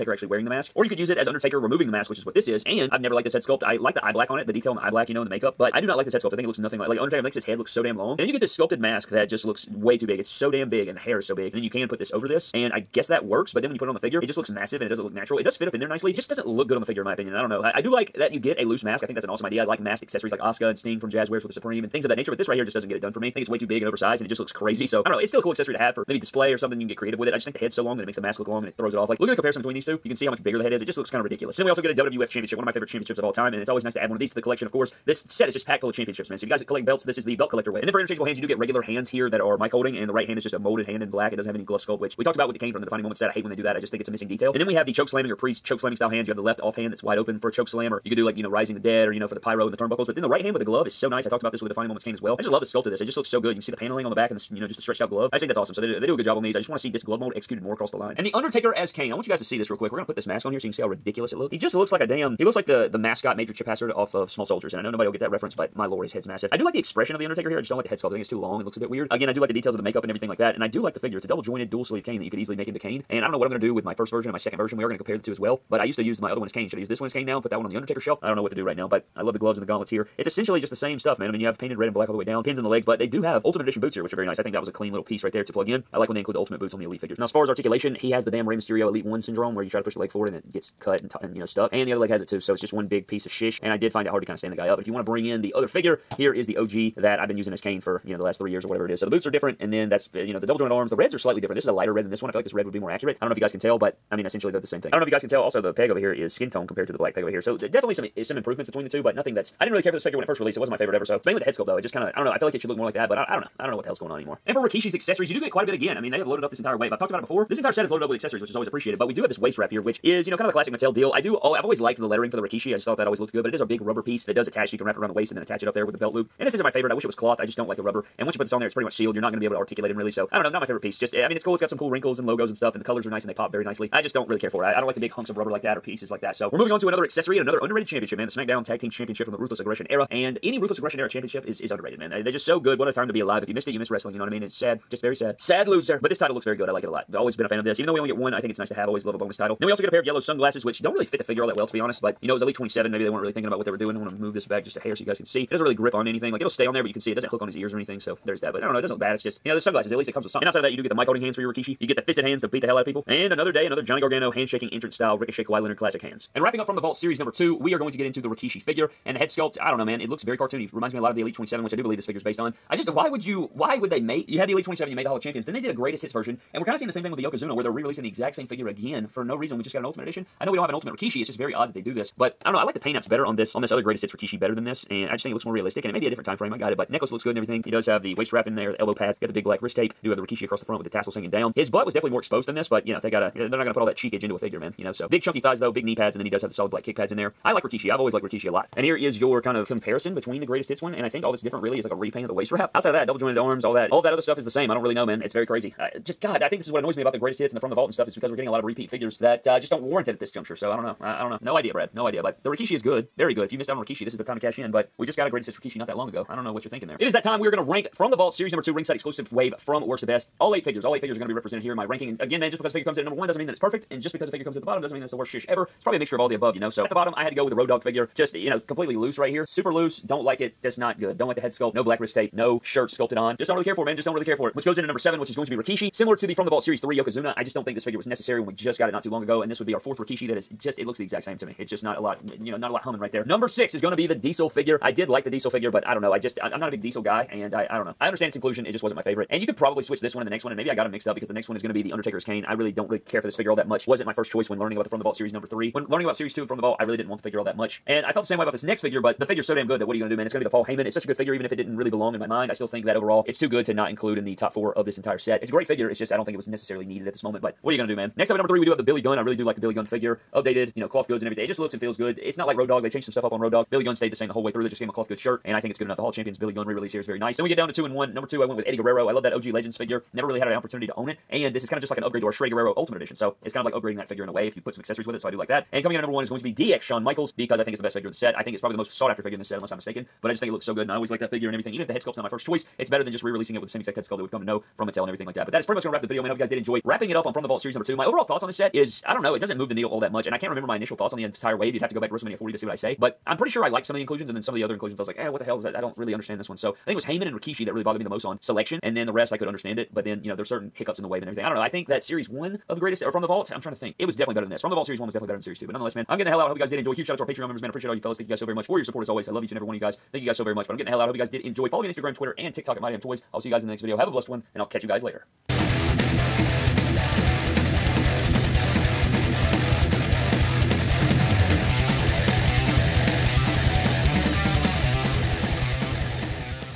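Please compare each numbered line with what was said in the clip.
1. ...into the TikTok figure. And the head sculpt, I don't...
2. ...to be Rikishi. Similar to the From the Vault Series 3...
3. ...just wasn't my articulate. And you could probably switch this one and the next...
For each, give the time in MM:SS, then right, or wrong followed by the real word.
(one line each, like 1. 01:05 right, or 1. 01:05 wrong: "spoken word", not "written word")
1. 02:48 wrong: "Rikishi", not "TikTok"
2. 03:55 right
3. 04:08 wrong: "favorite", not "articulate".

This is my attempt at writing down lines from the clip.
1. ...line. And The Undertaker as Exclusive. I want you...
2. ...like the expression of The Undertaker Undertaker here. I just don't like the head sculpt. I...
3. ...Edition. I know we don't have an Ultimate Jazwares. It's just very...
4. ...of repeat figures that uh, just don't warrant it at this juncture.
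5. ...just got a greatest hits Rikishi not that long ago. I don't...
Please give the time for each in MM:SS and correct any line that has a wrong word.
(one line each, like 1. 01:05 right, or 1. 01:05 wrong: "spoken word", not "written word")
1. 00:57 wrong: "Kane", not "Exclusive"
2. 01:06 right
3. 03:00 wrong: "Rikishi", not "Jazwares"
4. 03:28 right
5. 03:35 right.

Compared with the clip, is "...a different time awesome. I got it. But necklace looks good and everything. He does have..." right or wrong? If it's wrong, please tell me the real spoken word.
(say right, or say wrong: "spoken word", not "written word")
wrong: "frame", not "awesome".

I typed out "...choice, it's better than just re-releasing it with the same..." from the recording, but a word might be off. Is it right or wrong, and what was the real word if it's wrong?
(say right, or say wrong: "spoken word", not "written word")
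right.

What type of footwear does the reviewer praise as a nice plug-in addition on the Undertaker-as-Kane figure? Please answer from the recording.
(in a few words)
Ultimate Edition boots.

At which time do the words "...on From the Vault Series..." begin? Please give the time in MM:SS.
04:57.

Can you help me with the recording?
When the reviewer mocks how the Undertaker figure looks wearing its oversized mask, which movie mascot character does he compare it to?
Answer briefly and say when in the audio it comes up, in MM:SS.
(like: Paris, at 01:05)
Major Chip Hazard, at 01:03.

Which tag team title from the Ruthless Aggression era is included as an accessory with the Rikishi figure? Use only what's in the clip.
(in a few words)
SmackDown Tag Team Championship.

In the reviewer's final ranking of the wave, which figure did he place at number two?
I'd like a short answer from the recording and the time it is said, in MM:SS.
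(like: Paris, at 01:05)
Eddie Guerrero, at 04:38.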